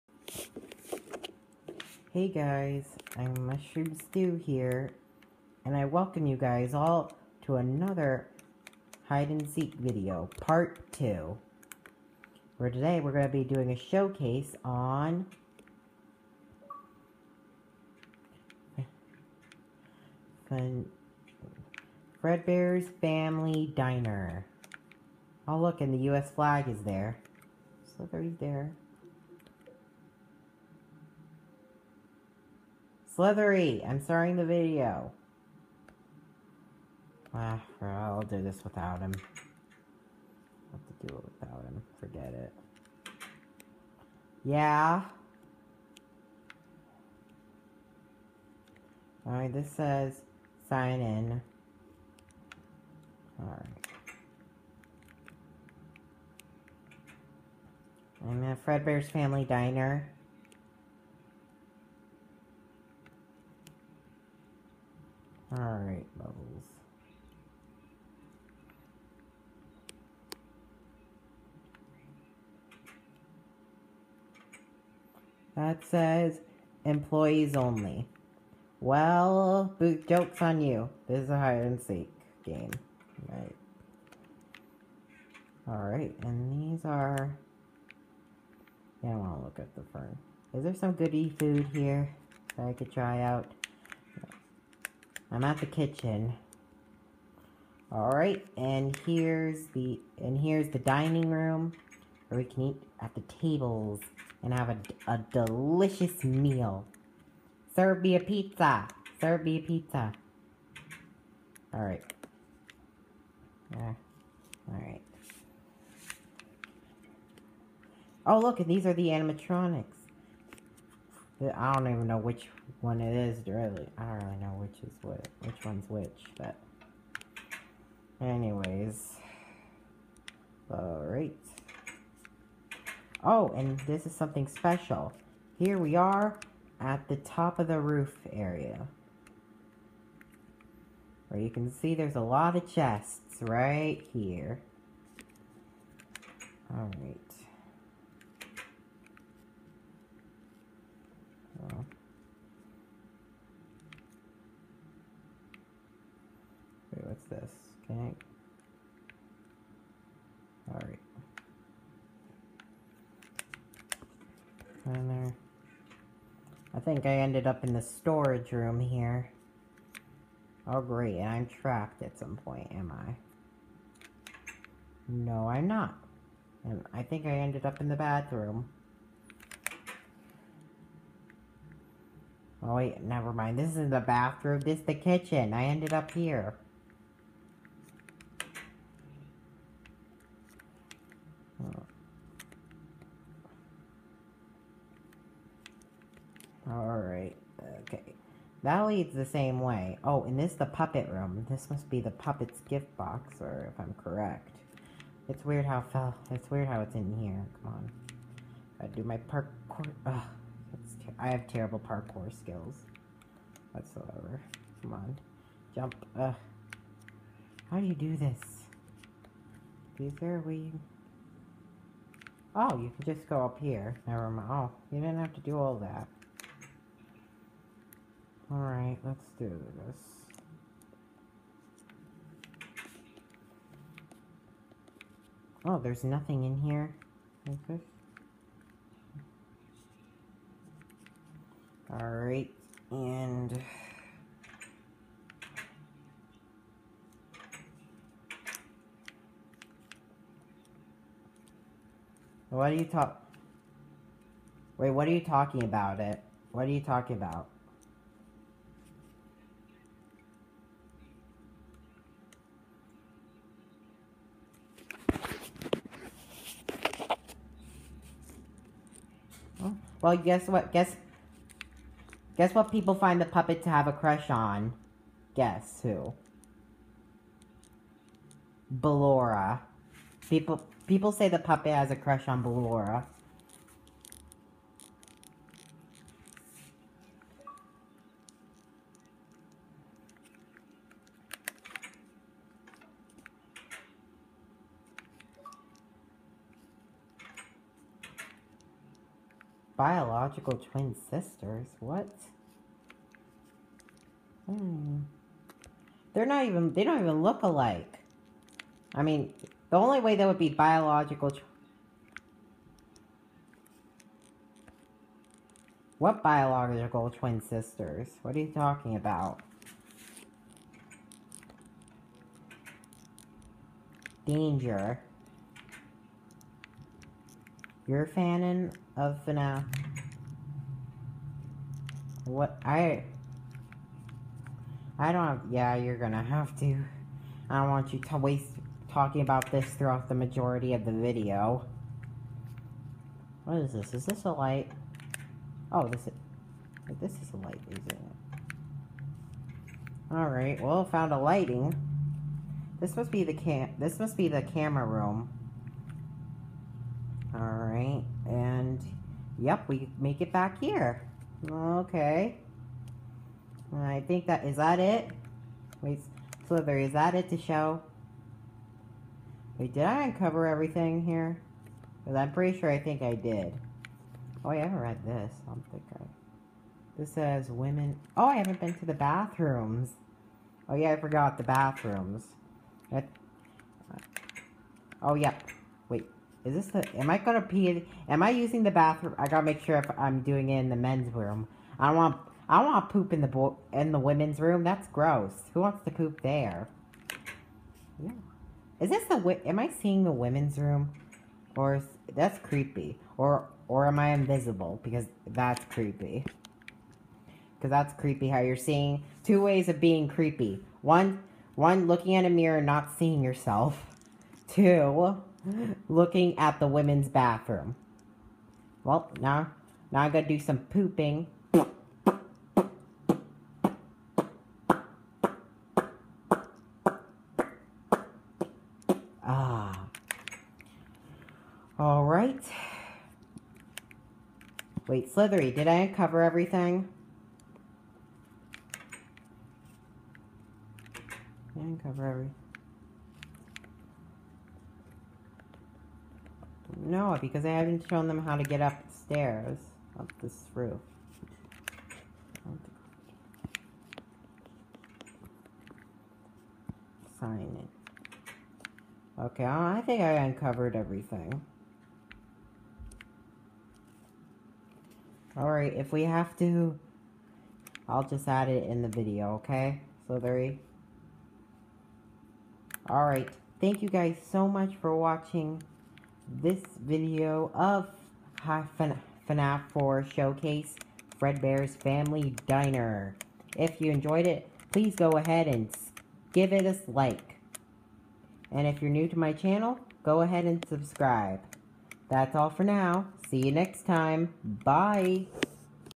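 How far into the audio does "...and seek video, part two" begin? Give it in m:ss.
0:09.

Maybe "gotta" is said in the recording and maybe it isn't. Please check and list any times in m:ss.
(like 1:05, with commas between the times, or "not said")
6:29, 7:00.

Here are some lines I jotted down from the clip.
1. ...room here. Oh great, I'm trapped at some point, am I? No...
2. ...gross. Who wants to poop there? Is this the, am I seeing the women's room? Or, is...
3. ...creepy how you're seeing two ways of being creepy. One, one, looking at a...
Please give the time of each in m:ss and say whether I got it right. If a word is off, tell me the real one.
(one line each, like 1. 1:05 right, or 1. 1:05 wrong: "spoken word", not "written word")
1. 2:48 right
2. 6:34 right
3. 6:47 right.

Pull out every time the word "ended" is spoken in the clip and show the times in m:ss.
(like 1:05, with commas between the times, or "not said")
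2:47, 2:57, 3:05.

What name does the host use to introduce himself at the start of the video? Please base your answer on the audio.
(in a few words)
Mushroom Stew.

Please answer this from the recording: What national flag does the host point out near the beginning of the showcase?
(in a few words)
U.S. flag.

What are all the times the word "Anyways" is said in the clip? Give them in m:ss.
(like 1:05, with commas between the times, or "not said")
2:08.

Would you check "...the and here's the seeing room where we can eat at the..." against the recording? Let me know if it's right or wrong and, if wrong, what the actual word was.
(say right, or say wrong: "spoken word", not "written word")
wrong: "dining", not "seeing".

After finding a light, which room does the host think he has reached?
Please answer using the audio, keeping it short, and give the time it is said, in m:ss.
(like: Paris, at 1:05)
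the camera room, at 5:54.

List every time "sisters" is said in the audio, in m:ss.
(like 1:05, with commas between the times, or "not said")
5:01, 5:17.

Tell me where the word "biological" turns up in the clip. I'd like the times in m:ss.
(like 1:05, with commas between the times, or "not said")
4:59, 5:10, 5:16.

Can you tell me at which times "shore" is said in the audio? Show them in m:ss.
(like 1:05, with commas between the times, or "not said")
not said.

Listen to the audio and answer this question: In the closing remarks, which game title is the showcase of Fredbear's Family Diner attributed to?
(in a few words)
FNAF 4.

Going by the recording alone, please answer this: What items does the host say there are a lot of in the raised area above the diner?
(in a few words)
chests.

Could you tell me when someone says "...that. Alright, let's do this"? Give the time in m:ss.
3:45.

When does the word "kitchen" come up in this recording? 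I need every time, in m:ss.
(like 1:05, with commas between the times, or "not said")
1:35, 3:04.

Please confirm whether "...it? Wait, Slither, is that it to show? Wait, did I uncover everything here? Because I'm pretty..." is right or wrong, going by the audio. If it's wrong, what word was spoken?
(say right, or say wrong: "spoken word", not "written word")
right.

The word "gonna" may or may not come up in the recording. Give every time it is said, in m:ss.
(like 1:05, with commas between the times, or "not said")
5:35, 6:27.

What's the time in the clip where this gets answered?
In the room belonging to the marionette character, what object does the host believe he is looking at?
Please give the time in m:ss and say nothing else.
3:22.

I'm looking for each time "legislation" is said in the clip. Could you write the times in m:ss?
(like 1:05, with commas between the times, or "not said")
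not said.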